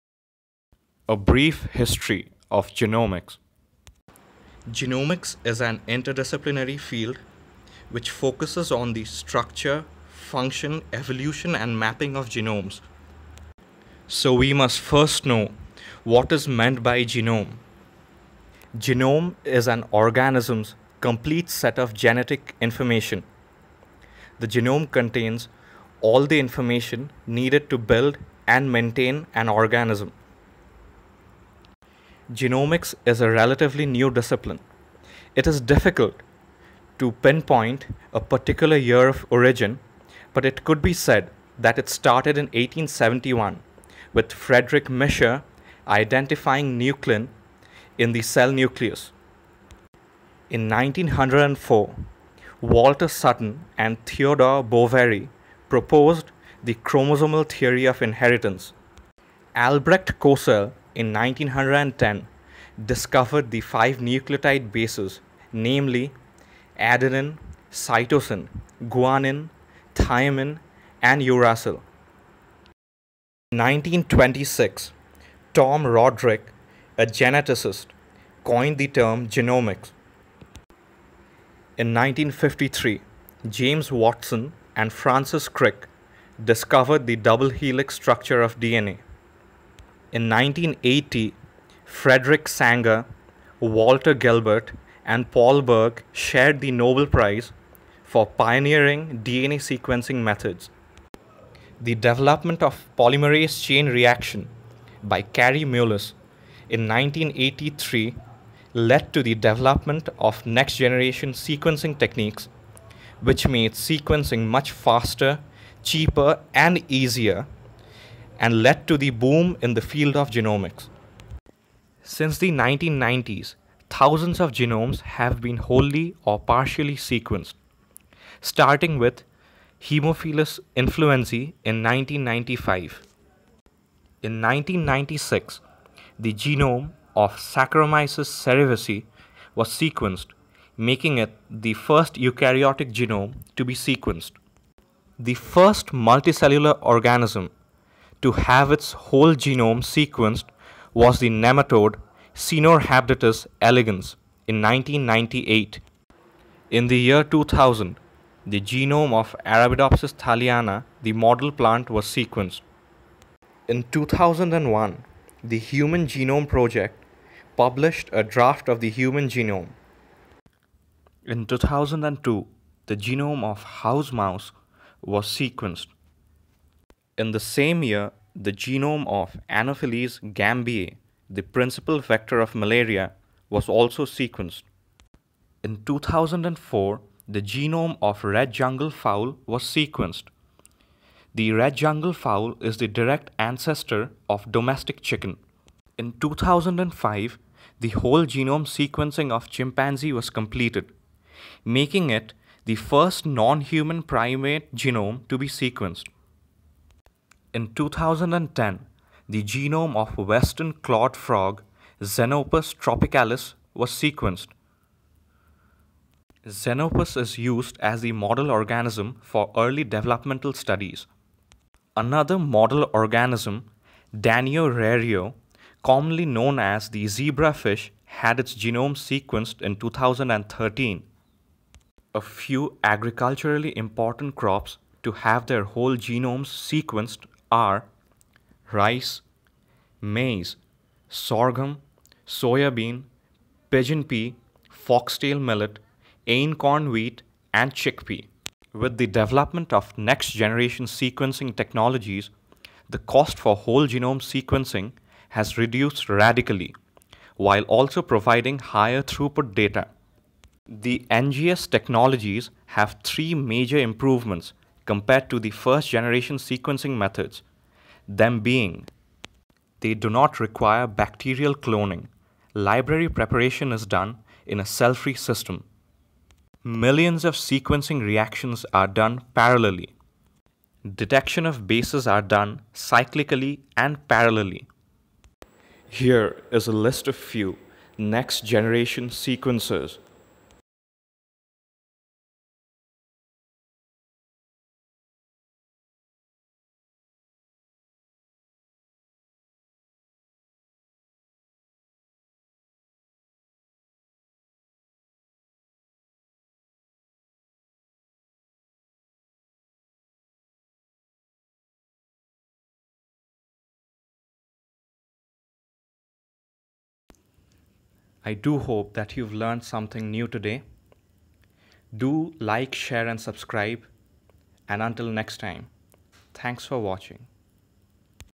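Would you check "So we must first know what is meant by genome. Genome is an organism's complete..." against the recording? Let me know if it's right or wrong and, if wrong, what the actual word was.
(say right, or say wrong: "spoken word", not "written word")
right.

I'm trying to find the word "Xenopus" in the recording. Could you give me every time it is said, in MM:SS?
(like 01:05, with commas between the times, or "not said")
03:32, 03:36.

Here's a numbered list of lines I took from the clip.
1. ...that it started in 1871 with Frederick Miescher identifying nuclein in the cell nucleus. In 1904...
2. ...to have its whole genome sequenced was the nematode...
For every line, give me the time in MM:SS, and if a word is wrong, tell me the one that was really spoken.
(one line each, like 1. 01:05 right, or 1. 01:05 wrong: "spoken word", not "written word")
1. 00:41 right
2. 02:28 right.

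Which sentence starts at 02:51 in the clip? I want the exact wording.
In 2002, the genome of house mouse was sequenced.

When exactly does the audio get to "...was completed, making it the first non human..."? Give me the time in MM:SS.
03:20.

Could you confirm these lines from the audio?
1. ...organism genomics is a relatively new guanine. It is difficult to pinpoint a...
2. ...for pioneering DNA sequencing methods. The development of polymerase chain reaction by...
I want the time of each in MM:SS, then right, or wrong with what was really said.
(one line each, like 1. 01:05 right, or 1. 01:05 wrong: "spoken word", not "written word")
1. 00:29 wrong: "discipline", not "guanine"
2. 01:38 right.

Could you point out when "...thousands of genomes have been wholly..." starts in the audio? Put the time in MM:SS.
02:03.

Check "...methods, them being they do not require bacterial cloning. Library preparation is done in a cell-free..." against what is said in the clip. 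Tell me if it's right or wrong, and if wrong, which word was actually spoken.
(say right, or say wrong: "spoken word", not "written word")
right.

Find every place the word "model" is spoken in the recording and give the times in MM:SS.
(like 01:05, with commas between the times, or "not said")
02:41, 03:38, 03:42.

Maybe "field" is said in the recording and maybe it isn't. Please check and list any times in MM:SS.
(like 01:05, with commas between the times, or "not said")
00:06, 01:59.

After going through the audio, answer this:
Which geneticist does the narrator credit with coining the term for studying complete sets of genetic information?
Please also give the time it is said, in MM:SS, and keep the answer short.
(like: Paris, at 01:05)
Tom Roderick, at 01:15.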